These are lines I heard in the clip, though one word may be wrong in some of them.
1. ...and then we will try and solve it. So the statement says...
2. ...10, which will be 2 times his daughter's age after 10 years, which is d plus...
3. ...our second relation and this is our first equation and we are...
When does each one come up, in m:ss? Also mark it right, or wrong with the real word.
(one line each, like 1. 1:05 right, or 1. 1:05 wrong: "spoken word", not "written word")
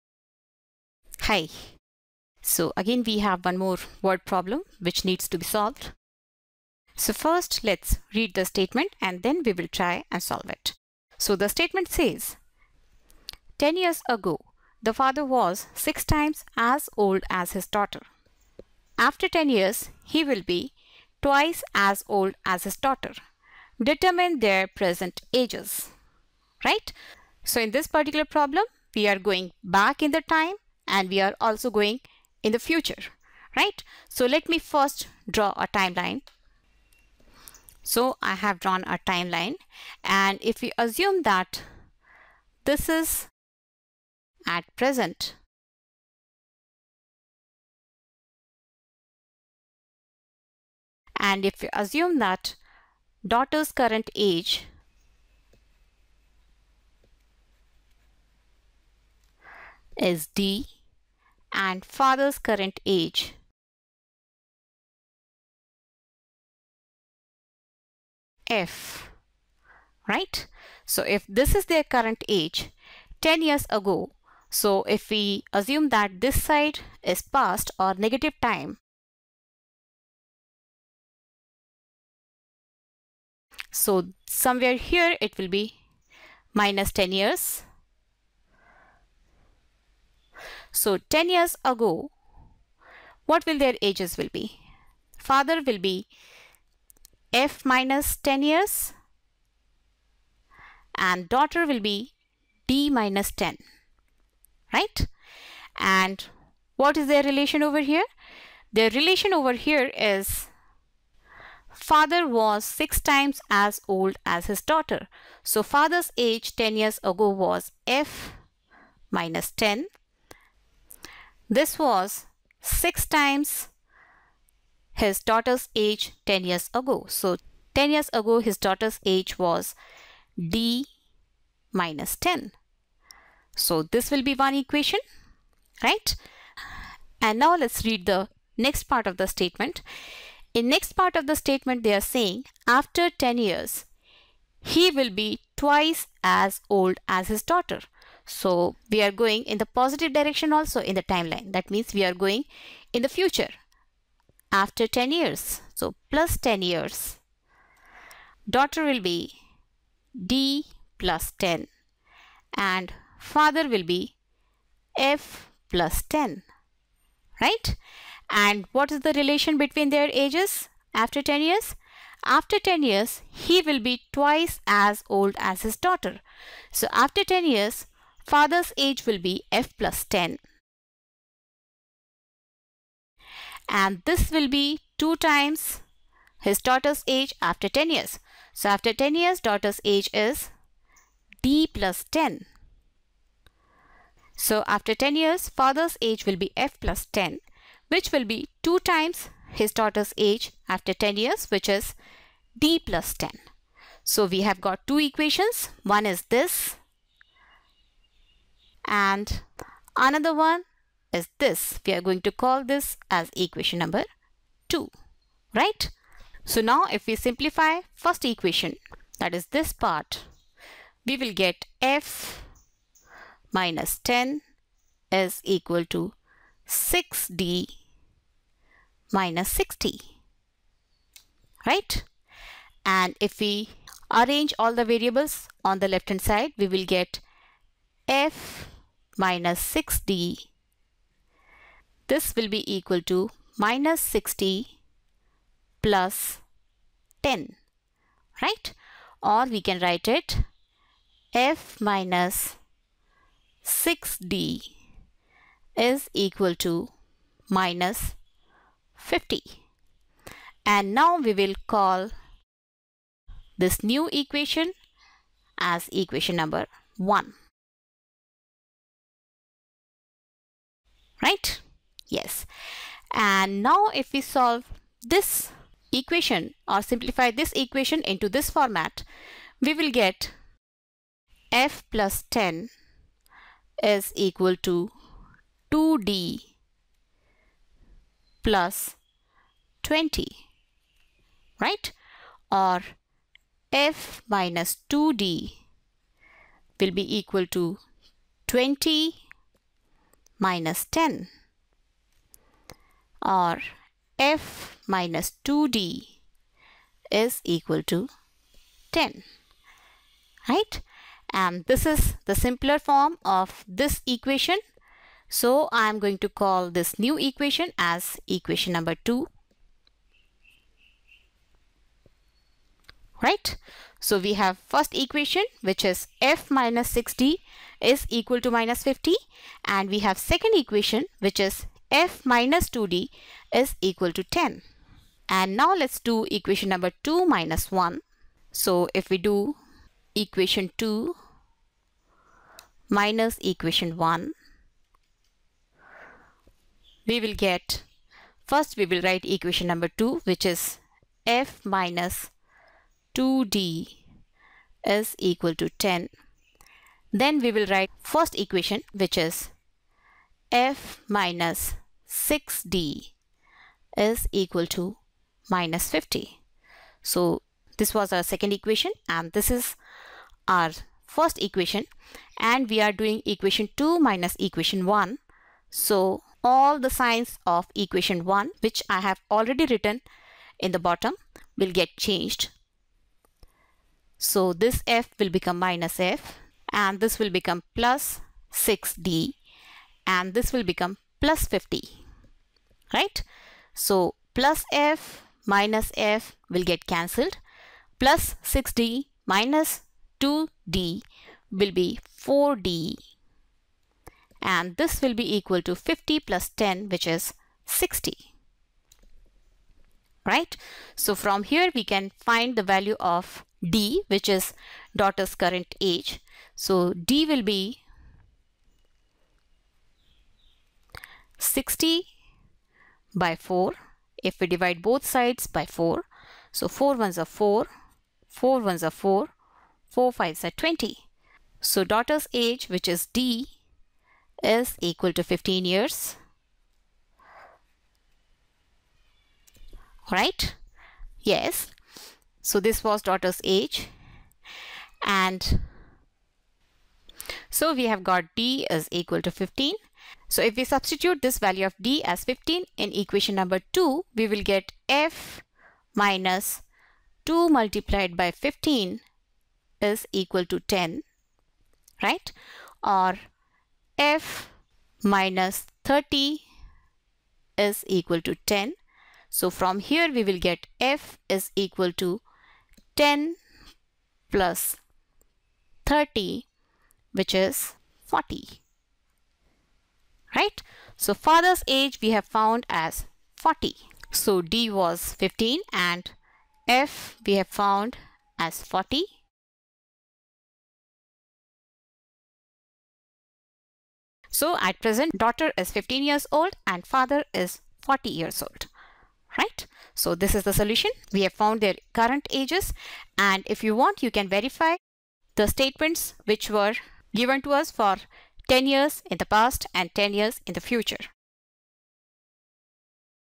1. 0:08 right
2. 3:17 right
3. 6:08 wrong: "equation", not "relation".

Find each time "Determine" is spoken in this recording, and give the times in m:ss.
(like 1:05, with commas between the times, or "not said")
0:23.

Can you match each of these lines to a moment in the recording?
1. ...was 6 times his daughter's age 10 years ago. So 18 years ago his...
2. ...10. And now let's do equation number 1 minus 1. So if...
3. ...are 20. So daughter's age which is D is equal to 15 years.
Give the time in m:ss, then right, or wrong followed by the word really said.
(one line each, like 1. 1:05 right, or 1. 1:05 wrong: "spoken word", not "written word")
1. 2:01 wrong: "10", not "18"
2. 5:34 wrong: "2", not "1"
3. 7:10 right.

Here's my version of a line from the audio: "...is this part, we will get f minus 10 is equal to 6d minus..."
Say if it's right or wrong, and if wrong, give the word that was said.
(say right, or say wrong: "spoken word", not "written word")
right.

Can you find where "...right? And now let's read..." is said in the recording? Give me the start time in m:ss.
2:15.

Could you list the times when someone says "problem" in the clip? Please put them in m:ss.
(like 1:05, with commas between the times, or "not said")
0:04, 0:28.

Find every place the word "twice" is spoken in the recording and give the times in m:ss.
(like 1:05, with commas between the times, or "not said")
0:21, 2:25, 2:54.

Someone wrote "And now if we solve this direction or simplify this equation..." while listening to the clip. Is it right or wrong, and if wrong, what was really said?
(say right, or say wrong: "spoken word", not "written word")
wrong: "equation", not "direction".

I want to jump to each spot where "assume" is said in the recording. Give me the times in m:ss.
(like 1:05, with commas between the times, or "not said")
0:40, 0:51, 1:15.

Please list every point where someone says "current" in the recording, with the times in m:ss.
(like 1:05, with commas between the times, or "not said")
0:53, 1:02, 1:11, 6:55, 8:21.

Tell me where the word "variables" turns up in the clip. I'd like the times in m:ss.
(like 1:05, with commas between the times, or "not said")
3:54.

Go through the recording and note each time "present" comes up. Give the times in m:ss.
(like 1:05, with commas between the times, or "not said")
0:24, 0:44, 8:14.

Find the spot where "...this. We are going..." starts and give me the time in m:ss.
3:31.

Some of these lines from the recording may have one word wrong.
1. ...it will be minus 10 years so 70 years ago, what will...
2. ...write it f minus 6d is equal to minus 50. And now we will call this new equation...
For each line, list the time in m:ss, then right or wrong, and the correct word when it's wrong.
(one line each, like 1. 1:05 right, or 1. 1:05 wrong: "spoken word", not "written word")
1. 1:25 wrong: "10", not "70"
2. 4:09 right.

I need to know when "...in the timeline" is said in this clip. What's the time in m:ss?
2:30.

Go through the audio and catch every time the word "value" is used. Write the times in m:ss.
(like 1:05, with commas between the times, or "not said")
6:52, 7:31.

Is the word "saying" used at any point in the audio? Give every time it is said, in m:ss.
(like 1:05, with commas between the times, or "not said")
2:22.